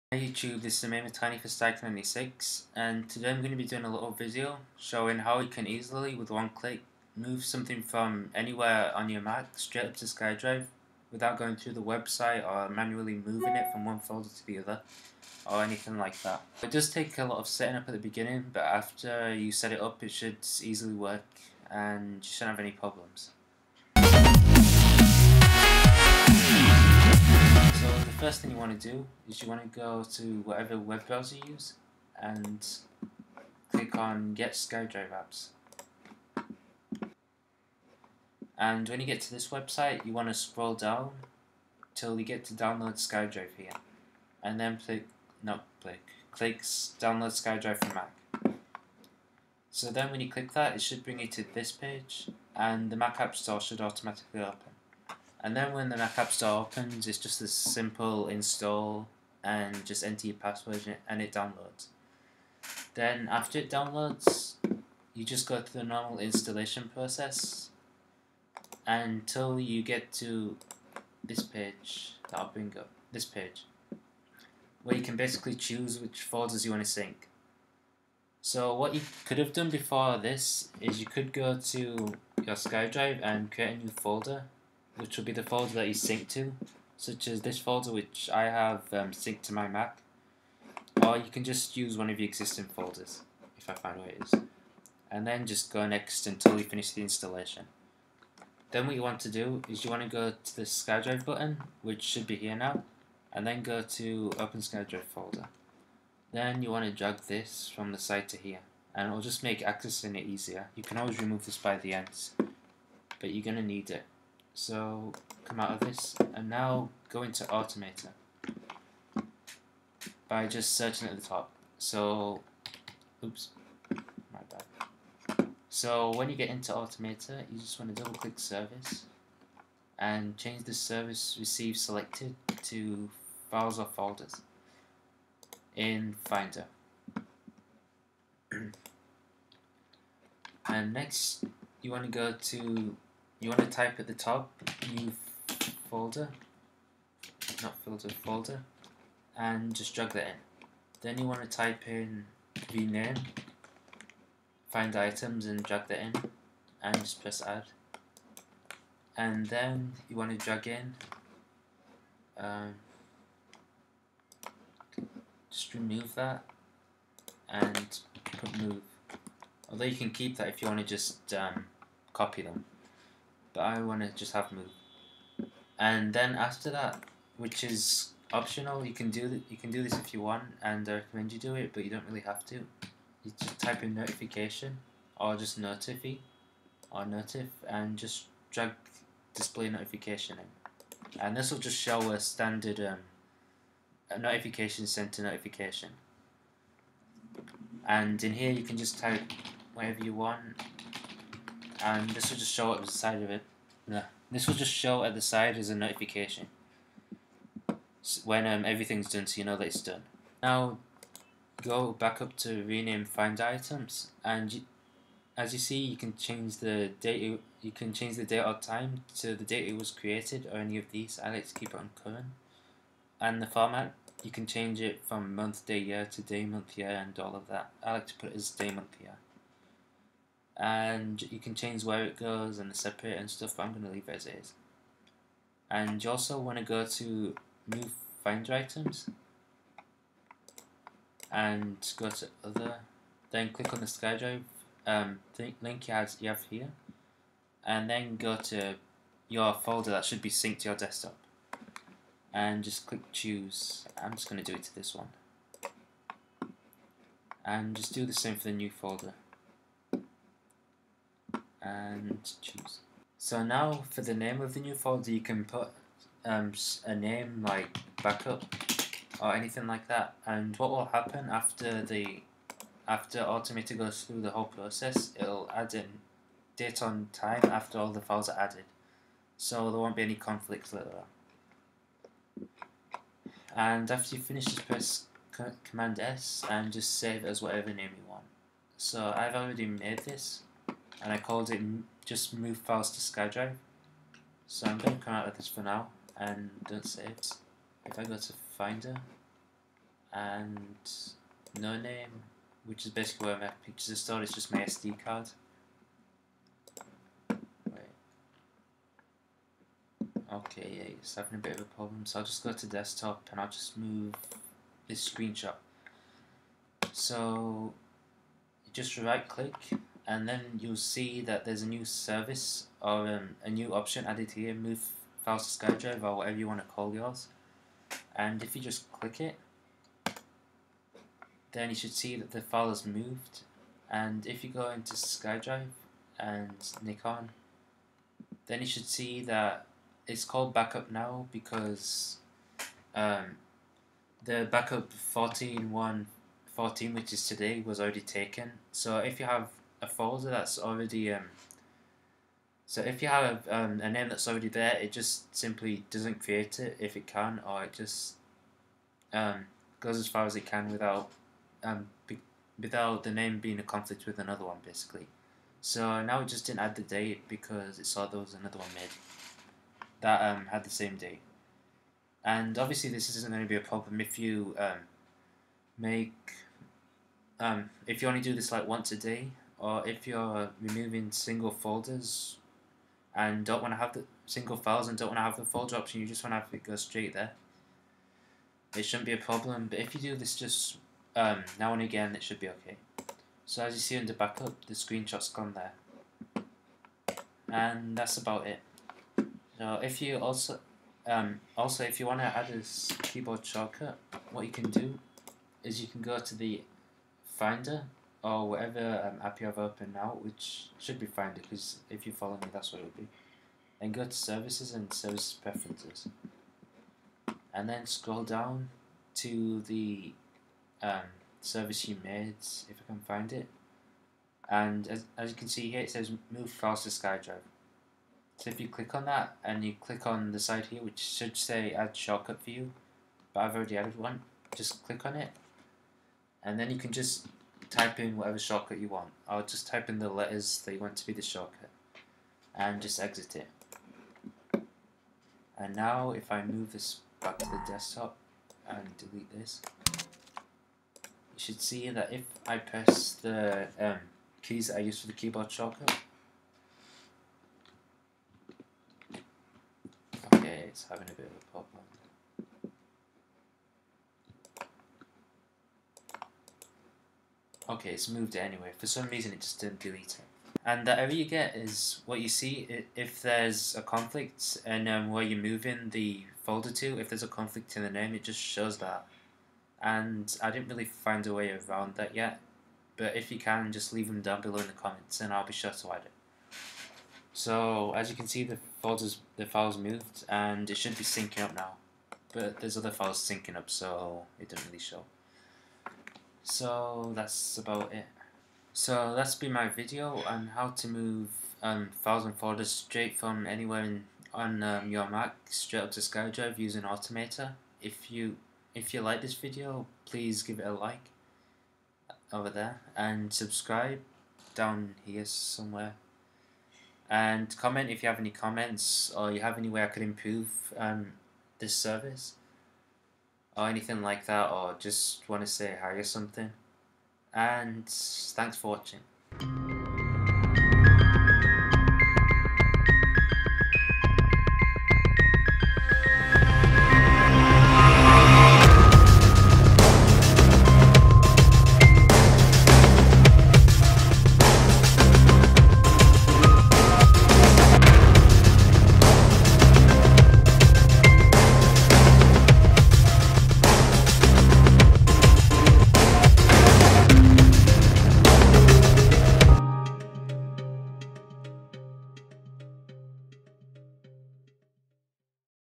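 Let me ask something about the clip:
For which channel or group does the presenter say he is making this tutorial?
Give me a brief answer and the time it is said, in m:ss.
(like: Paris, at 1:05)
Stike96, at 0:01.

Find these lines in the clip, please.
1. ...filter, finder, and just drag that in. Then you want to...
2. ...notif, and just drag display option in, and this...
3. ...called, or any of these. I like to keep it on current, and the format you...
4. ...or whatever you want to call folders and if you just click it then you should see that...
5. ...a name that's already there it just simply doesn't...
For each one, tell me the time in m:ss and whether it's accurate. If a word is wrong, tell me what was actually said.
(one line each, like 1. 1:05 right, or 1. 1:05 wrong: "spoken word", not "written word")
1. 2:27 wrong: "folder", not "finder"
2. 3:07 wrong: "notification", not "option"
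3. 3:39 wrong: "created", not "called"
4. 5:26 wrong: "yours", not "folders"
5. 5:53 right.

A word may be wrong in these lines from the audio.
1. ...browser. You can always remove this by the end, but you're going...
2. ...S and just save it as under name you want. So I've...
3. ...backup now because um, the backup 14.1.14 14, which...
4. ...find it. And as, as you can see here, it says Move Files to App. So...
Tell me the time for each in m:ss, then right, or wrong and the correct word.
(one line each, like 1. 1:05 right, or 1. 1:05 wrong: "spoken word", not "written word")
1. 1:50 wrong: "easier", not "browser"
2. 4:45 wrong: "whatever", not "under"
3. 5:40 right
4. 7:03 wrong: "SkyDrive", not "App".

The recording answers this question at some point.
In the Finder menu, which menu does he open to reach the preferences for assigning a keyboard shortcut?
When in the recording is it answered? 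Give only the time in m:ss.
6:54.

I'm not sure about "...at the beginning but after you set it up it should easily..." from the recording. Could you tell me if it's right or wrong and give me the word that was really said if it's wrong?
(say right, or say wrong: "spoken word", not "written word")
right.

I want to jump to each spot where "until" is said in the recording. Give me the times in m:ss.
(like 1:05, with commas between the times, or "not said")
1:08, 1:36.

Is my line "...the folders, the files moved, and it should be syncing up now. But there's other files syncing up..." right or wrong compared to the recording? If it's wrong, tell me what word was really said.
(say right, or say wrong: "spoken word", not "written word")
right.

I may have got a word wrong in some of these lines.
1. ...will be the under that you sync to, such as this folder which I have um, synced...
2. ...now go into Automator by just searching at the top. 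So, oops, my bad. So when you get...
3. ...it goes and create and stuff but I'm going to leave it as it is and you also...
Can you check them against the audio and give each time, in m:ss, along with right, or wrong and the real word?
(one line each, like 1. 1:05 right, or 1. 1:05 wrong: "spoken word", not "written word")
1. 1:25 wrong: "folder", not "under"
2. 1:56 right
3. 3:52 wrong: "separate", not "create".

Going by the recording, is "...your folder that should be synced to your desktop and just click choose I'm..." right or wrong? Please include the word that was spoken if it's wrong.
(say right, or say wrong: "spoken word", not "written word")
right.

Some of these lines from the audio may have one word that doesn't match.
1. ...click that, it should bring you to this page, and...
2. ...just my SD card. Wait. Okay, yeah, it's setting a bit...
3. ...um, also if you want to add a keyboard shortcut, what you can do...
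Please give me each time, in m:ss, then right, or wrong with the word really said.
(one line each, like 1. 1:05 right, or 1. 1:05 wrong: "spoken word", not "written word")
1. 0:50 right
2. 5:04 wrong: "having", not "setting"
3. 6:41 right.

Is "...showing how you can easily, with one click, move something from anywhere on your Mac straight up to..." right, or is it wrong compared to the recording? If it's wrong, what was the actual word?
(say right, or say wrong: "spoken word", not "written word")
right.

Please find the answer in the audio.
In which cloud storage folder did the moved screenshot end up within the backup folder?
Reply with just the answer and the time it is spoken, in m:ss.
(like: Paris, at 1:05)
Nikon, at 5:36.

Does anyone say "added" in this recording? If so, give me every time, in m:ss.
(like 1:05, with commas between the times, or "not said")
4:38, 5:24, 7:13.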